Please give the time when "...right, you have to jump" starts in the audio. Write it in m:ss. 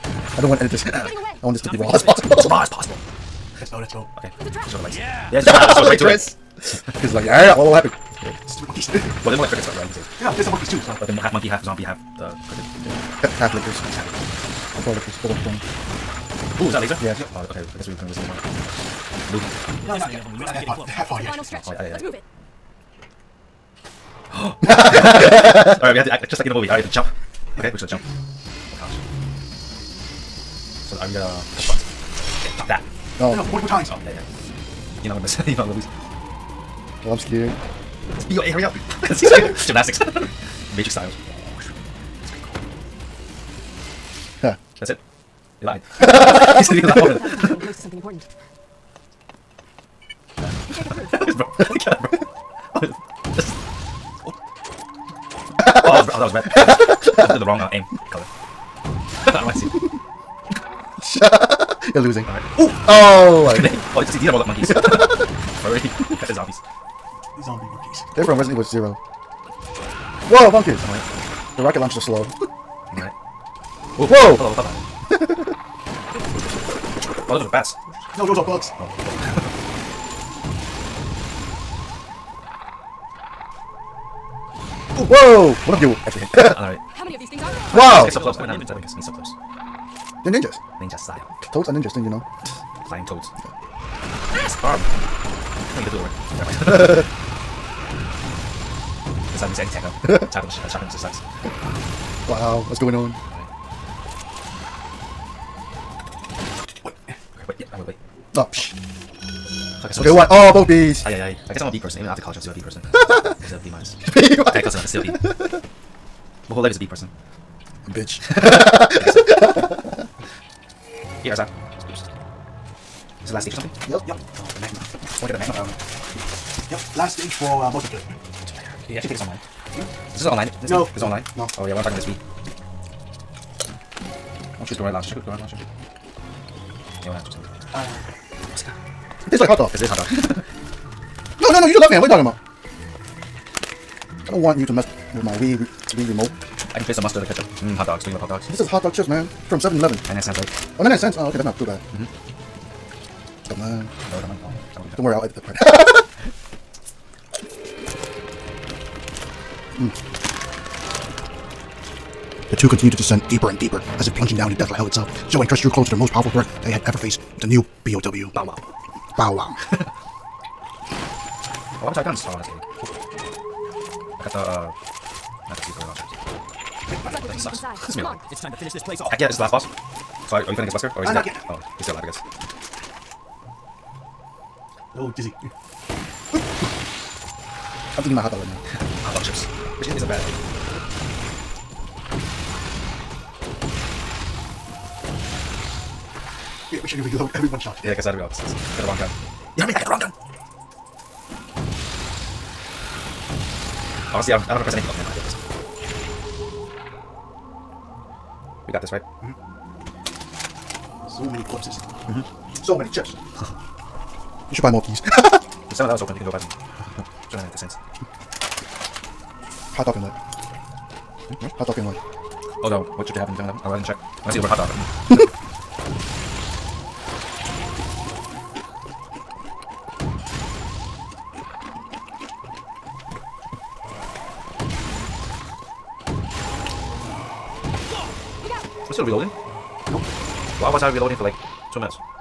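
0:26.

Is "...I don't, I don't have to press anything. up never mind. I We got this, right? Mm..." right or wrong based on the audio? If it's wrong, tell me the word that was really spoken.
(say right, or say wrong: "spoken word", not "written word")
right.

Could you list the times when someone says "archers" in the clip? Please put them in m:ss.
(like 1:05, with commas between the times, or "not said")
2:56.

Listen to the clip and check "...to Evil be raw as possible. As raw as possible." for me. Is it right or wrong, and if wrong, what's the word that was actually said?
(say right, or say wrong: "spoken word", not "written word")
wrong: "Not", not "Evil".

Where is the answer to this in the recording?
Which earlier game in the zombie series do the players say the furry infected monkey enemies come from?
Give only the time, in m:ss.
1:08.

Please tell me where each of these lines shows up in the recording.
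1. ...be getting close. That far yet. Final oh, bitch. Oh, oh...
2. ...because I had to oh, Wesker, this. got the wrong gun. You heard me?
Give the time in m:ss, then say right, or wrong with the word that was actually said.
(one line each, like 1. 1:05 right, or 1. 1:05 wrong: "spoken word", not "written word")
1. 0:20 wrong: "stretch", not "bitch"
2. 3:17 wrong: "This", not "Wesker".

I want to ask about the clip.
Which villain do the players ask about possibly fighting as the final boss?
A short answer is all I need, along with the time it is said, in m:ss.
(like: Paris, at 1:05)
Wesker, at 3:00.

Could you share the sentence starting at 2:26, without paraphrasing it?
I can taste some mustard and ketchup.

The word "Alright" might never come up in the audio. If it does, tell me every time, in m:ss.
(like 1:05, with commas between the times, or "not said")
1:02, 1:12, 1:26.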